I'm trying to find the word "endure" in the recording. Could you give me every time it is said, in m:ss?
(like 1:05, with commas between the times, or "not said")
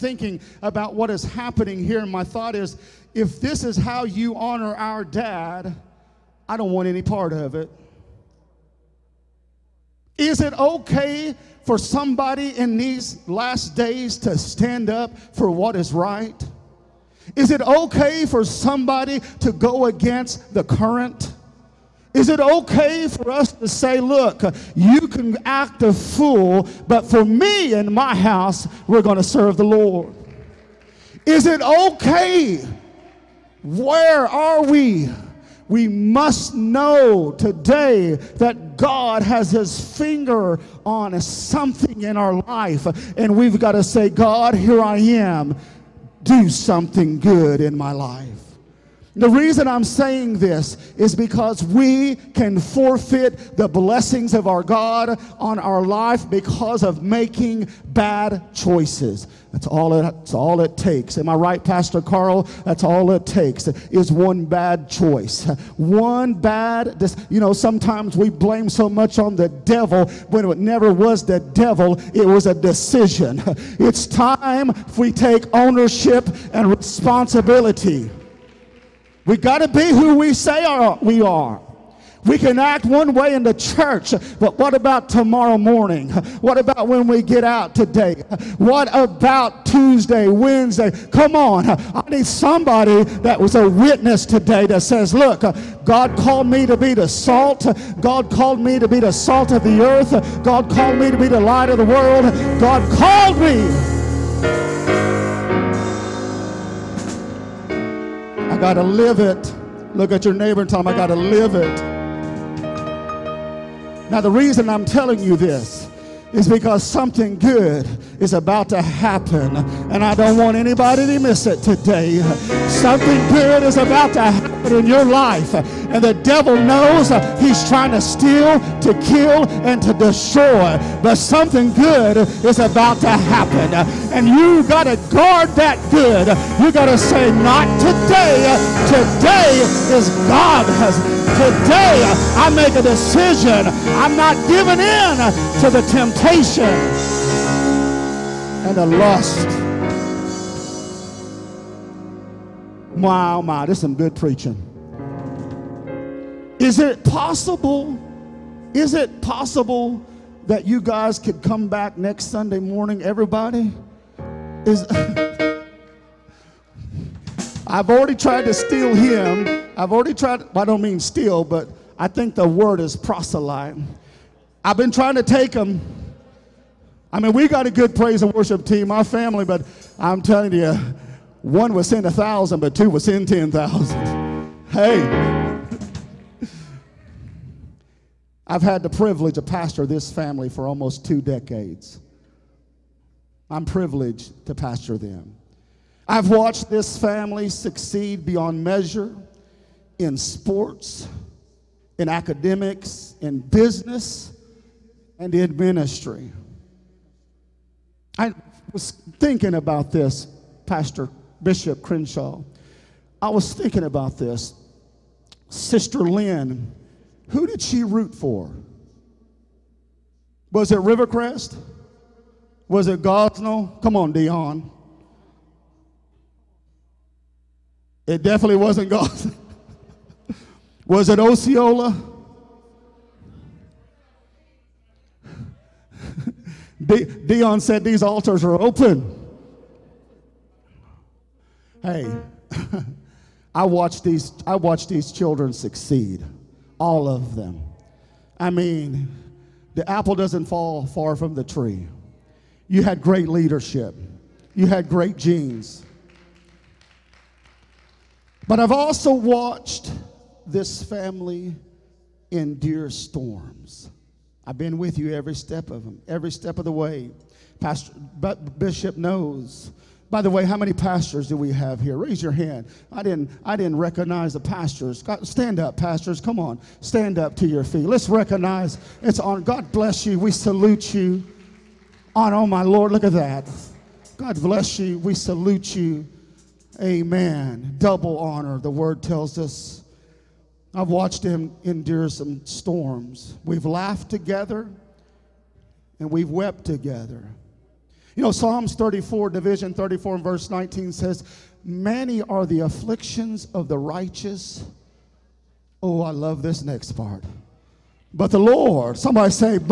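4:22, 4:51.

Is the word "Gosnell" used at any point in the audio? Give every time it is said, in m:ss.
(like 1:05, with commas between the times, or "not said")
3:43, 3:48.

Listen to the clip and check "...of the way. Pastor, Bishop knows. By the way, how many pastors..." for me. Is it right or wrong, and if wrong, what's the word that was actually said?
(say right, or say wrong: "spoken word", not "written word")
right.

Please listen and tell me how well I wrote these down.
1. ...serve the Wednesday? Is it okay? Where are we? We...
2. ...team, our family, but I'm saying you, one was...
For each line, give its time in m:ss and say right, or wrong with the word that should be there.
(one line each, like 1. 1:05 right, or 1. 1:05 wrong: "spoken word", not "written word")
1. 0:29 wrong: "Lord", not "Wednesday"
2. 2:58 wrong: "telling", not "saying".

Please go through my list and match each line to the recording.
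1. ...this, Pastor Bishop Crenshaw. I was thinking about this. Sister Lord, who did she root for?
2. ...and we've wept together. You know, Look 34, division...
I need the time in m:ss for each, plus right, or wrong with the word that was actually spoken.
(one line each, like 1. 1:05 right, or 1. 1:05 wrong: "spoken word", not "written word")
1. 3:29 wrong: "Lynn", not "Lord"
2. 4:56 wrong: "Psalms", not "Look".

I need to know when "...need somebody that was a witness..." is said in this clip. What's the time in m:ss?
1:32.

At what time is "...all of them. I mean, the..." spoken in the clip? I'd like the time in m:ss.
4:06.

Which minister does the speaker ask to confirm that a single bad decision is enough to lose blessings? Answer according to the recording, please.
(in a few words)
Pastor Carl.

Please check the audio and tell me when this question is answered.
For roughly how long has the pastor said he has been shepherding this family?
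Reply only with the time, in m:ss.
3:10.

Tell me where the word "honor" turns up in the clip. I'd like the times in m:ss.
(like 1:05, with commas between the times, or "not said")
0:04, 4:48.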